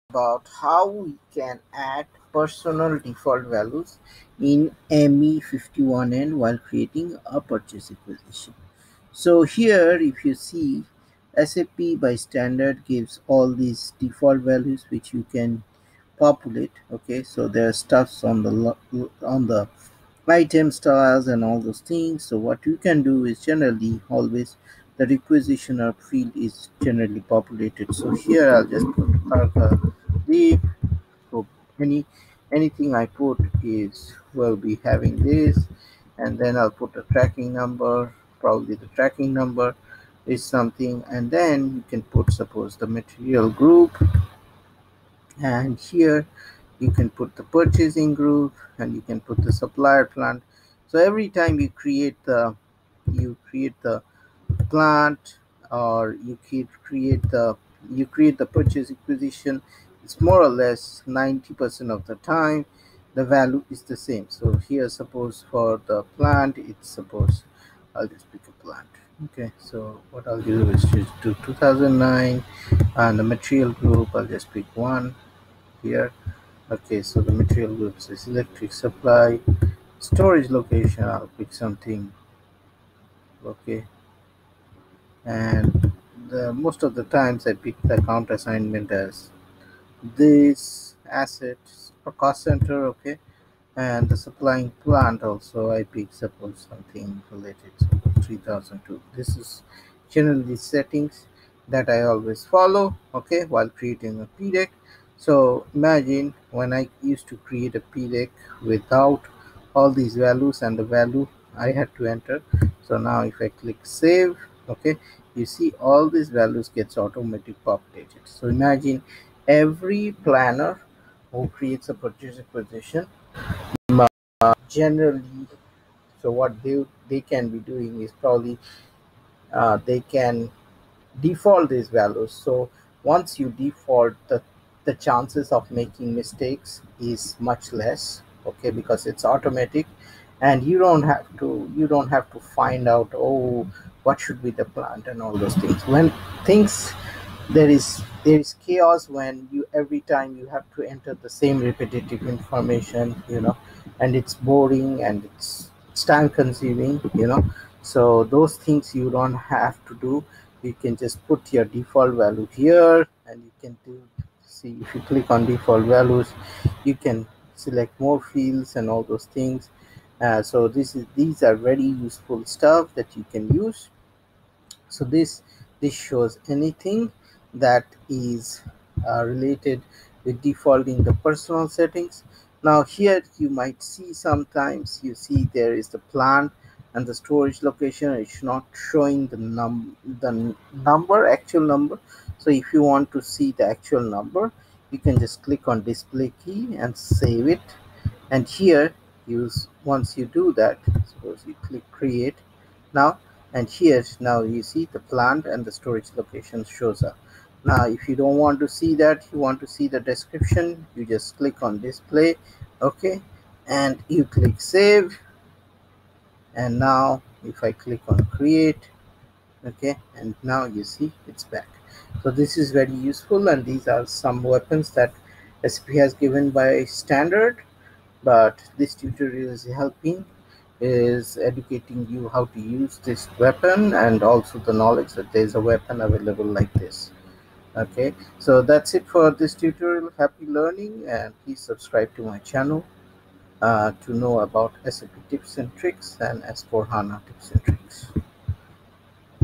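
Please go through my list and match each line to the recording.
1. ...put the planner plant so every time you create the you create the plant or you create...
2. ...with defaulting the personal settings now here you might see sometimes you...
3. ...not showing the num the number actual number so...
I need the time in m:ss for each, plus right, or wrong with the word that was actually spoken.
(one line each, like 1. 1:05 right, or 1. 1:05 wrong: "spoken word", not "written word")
1. 0:49 wrong: "supplier", not "planner"
2. 3:00 right
3. 3:08 right.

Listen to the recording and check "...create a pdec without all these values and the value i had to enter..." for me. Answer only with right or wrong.
right.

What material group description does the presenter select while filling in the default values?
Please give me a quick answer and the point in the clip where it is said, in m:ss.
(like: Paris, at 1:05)
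electric supply, at 1:18.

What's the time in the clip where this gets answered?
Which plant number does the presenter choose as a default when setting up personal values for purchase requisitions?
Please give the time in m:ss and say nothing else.
1:11.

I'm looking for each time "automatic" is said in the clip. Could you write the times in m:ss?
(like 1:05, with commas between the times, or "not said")
1:56, 2:19.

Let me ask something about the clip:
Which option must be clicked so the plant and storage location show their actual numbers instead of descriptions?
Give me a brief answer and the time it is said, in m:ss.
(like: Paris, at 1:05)
display key, at 3:15.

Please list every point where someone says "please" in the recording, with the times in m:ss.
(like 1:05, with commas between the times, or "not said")
4:01.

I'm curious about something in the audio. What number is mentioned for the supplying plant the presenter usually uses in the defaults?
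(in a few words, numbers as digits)
3002.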